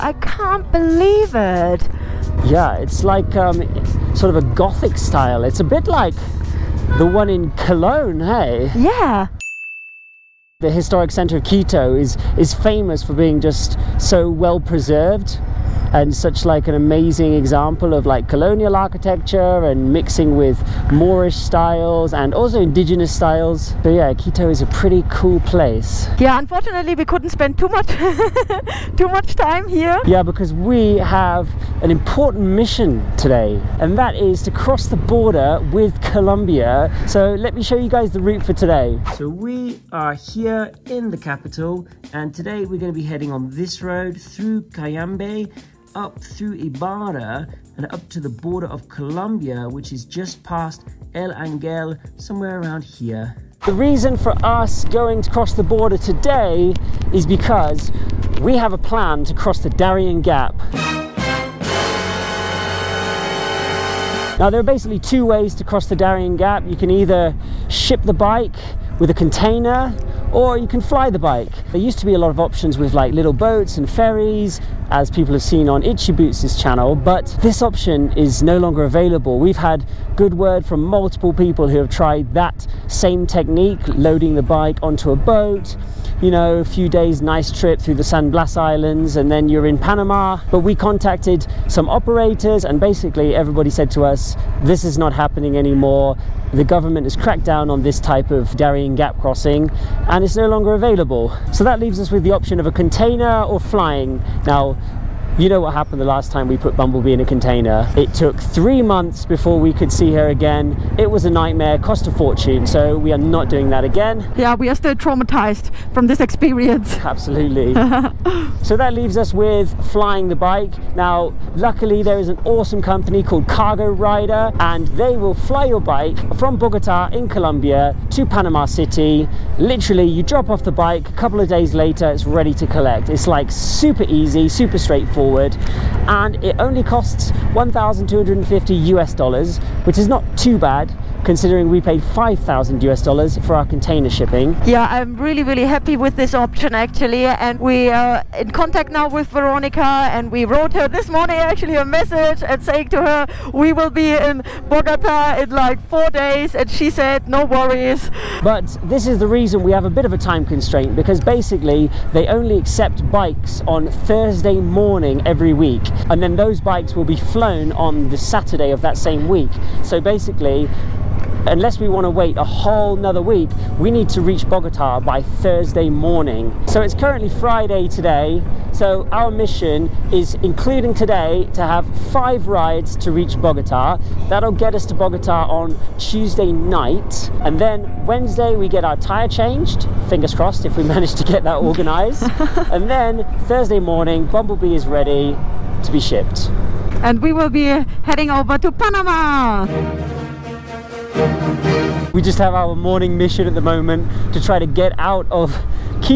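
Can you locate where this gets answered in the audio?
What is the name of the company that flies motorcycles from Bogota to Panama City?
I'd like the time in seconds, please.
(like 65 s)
123 s.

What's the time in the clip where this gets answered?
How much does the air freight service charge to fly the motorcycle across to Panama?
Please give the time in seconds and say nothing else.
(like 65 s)
137 s.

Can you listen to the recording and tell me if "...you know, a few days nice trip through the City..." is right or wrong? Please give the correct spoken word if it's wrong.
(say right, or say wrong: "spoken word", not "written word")
wrong: "San", not "City".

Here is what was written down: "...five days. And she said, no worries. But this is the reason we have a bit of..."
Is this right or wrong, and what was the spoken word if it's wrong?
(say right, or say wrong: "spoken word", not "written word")
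wrong: "four", not "five".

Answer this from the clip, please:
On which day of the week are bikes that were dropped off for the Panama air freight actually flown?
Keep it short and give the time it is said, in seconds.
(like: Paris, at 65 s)
Saturday, at 168 s.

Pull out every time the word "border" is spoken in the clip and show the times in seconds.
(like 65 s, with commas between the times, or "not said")
34 s, 48 s, 55 s.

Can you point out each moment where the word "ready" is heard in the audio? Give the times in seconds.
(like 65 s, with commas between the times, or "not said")
132 s, 194 s.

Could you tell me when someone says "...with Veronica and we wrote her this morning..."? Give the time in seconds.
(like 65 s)
149 s.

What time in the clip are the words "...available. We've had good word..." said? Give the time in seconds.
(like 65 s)
78 s.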